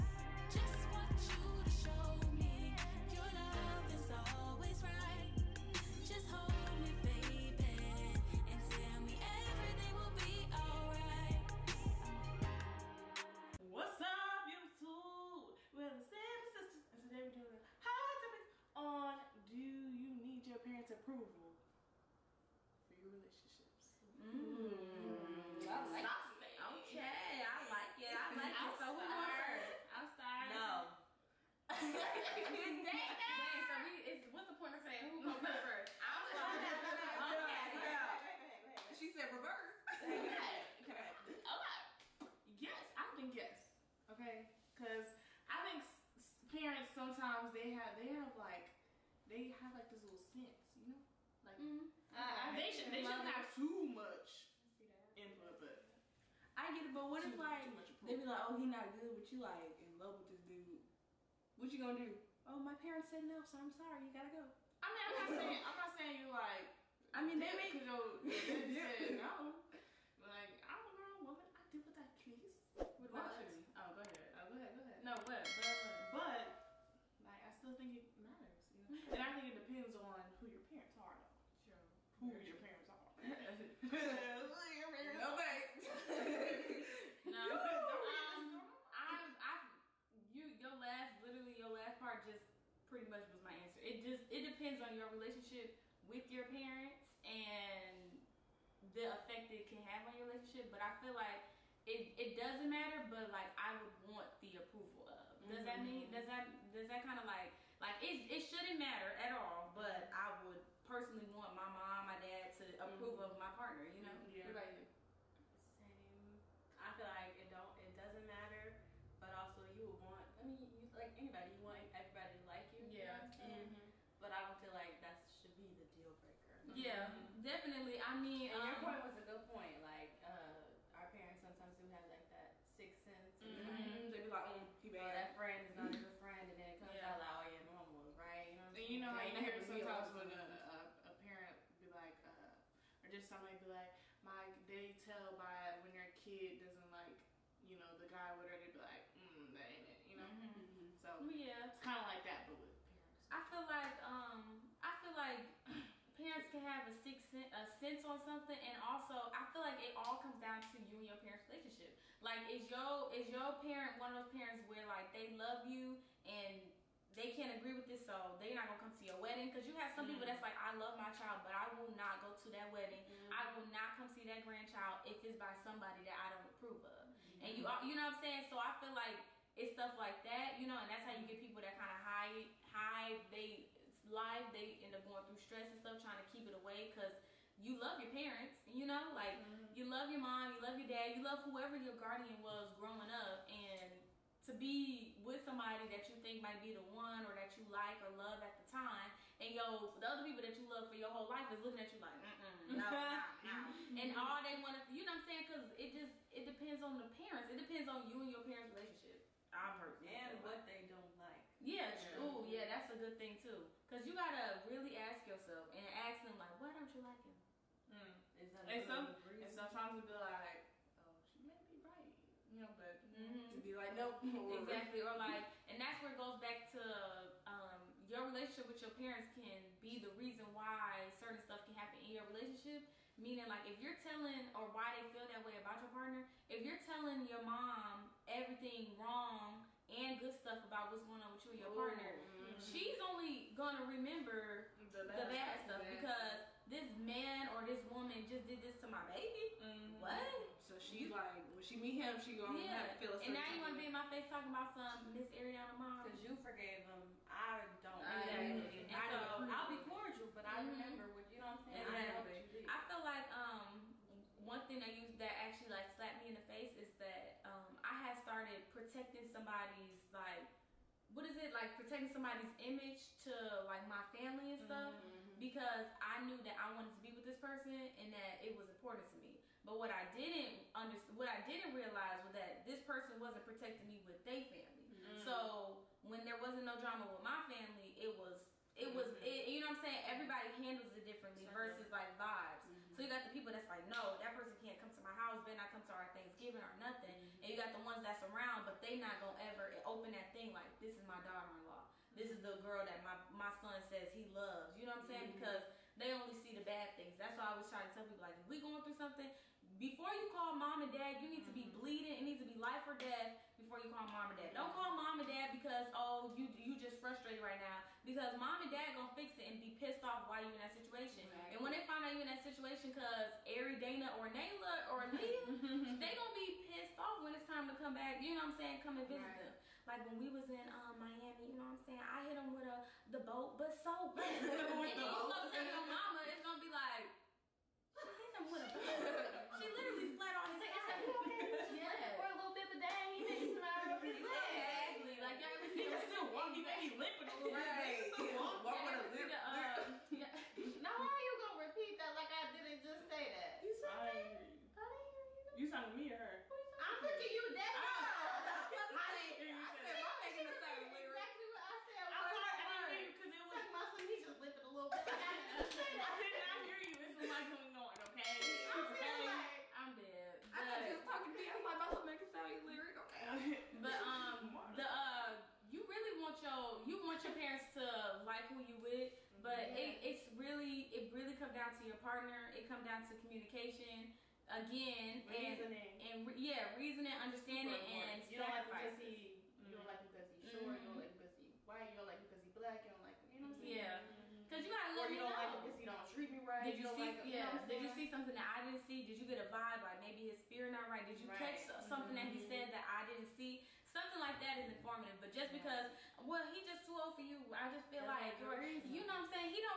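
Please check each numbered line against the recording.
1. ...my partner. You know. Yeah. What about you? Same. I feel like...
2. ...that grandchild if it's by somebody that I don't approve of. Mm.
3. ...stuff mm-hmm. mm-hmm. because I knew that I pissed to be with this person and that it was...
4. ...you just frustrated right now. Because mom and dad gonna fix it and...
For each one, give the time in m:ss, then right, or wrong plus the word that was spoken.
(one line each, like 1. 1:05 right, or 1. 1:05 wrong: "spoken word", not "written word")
1. 1:53 right
2. 2:54 right
3. 4:34 wrong: "wanted", not "pissed"
4. 5:16 right.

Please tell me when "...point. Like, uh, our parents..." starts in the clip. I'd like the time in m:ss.
2:09.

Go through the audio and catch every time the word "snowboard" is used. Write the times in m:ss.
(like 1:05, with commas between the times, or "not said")
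not said.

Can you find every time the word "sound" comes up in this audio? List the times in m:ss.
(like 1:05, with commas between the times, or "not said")
6:00, 6:12.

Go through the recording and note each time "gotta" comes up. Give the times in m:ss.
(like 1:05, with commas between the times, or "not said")
1:04, 3:34, 6:34.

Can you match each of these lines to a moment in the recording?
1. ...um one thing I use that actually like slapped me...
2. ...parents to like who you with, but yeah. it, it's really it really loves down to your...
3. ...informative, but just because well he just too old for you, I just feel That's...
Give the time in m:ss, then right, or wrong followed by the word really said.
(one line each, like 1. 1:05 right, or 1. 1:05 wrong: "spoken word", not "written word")
1. 4:23 right
2. 6:17 wrong: "comes", not "loves"
3. 6:44 right.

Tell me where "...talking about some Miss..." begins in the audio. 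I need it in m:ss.
4:14.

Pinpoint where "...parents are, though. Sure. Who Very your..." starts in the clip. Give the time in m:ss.
1:20.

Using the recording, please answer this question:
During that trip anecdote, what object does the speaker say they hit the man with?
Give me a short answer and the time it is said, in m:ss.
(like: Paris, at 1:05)
the boat, at 5:33.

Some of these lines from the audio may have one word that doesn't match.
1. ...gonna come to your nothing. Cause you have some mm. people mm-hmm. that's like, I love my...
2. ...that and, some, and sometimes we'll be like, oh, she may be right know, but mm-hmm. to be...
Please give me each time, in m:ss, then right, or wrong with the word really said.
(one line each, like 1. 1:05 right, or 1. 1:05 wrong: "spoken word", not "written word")
1. 2:48 wrong: "wedding", not "nothing"
2. 3:38 right.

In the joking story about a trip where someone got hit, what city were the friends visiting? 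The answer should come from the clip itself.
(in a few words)
Miami.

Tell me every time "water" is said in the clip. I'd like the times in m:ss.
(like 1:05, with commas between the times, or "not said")
not said.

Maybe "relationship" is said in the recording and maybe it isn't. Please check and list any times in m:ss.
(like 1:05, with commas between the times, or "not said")
1:35, 1:40, 2:41, 3:28, 3:48, 3:52.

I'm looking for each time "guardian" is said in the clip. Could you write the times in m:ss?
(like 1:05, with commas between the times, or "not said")
3:11.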